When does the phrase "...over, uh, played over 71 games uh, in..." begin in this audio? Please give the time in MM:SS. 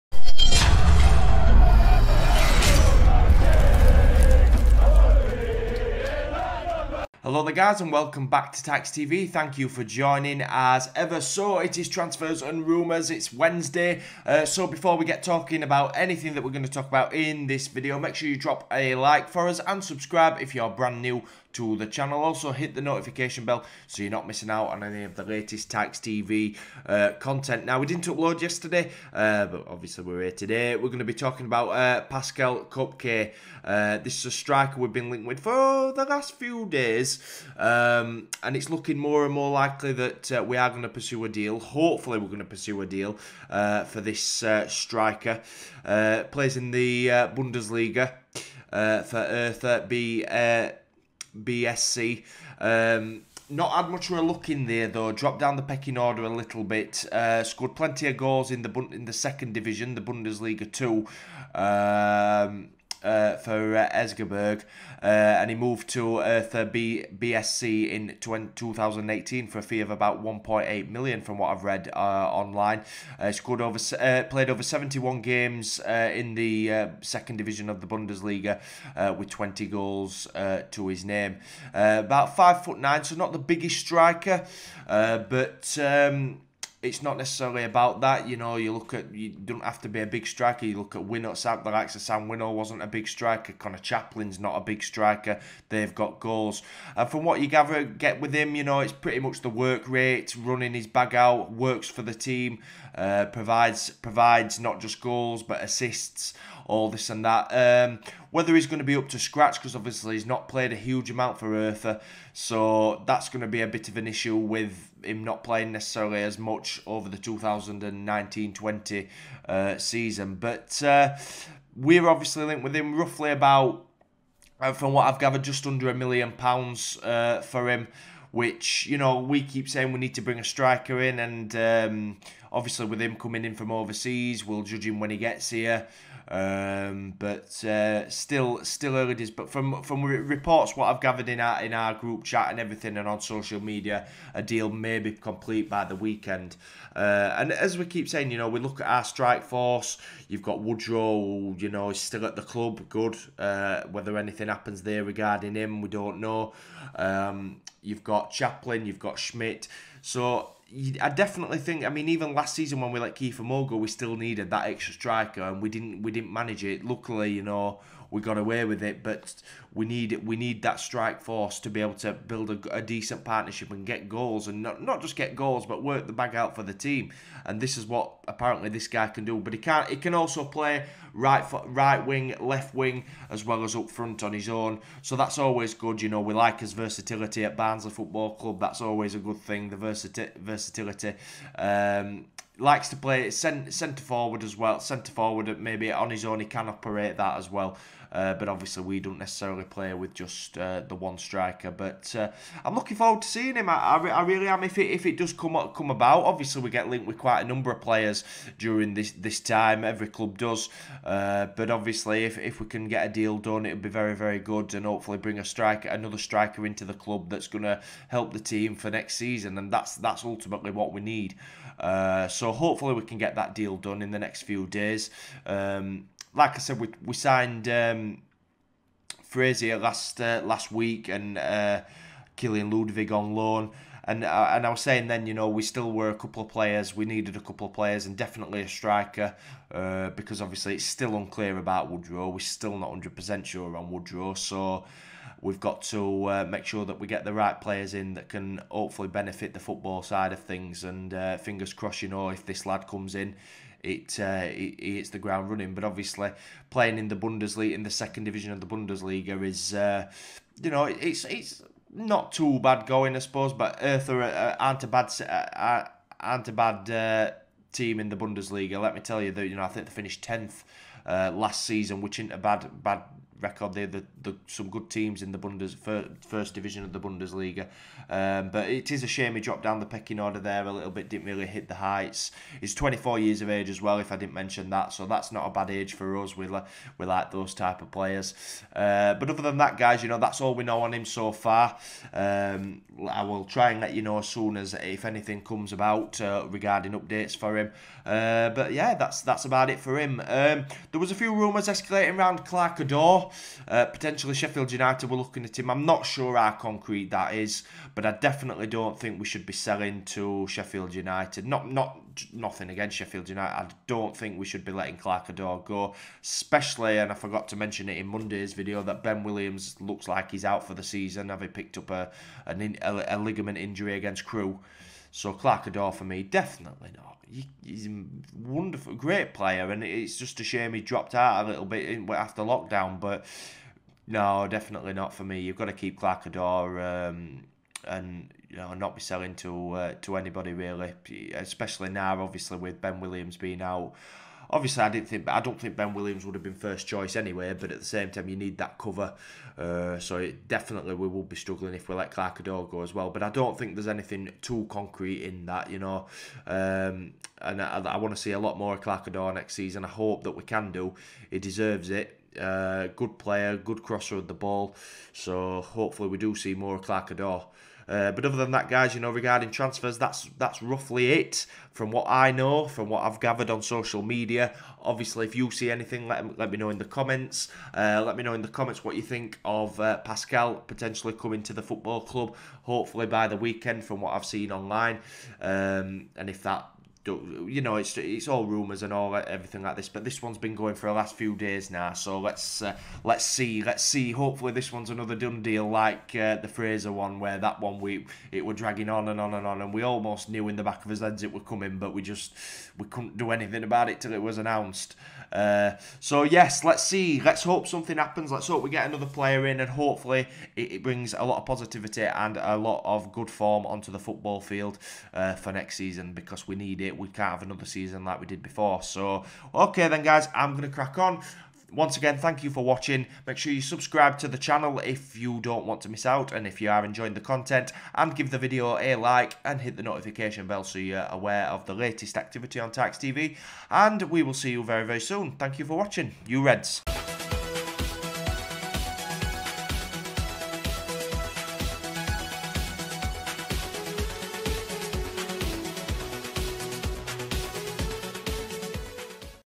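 01:13.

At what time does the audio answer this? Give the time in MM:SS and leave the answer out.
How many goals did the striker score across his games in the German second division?
01:19.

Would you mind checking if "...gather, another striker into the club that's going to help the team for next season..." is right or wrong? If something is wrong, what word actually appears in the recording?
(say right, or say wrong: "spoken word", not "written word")
wrong: "striker", not "gather".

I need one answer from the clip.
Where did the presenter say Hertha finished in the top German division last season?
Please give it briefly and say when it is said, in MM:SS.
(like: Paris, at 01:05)
tenth, at 04:30.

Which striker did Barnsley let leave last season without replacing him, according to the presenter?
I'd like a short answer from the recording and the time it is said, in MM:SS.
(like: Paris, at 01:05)
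Kiefer Moore, at 02:43.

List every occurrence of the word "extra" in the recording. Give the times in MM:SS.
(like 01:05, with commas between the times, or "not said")
02:44.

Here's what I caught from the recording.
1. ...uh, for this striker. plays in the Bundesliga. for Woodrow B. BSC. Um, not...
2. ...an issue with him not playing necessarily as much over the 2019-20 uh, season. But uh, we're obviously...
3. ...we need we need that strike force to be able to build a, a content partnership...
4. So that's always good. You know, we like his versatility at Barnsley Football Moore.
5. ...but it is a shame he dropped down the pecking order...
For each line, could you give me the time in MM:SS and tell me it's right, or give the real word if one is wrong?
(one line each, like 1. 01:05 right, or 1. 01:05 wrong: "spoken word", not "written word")
1. 00:43 wrong: "Hertha", not "Woodrow"
2. 01:53 right
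3. 02:49 wrong: "decent", not "content"
4. 03:05 wrong: "Club", not "Moore"
5. 04:38 right.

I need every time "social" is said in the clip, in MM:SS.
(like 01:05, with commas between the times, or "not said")
02:23, 06:13.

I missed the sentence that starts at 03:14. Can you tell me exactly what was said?
Centre forward, maybe on his own, he can operate that as well.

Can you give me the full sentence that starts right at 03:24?
If it if it does come come about, obviously we get linked with quite a number of players during this this time.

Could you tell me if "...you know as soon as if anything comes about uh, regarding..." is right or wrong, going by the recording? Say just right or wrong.
right.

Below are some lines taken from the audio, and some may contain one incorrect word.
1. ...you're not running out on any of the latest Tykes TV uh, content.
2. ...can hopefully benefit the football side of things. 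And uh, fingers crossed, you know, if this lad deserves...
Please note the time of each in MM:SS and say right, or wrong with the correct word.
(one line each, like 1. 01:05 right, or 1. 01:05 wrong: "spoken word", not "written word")
1. 00:24 wrong: "missing", not "running"
2. 04:08 wrong: "comes", not "deserves".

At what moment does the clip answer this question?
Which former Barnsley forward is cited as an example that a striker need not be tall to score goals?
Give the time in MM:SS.
01:32.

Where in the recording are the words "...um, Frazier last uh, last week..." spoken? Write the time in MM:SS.
03:47.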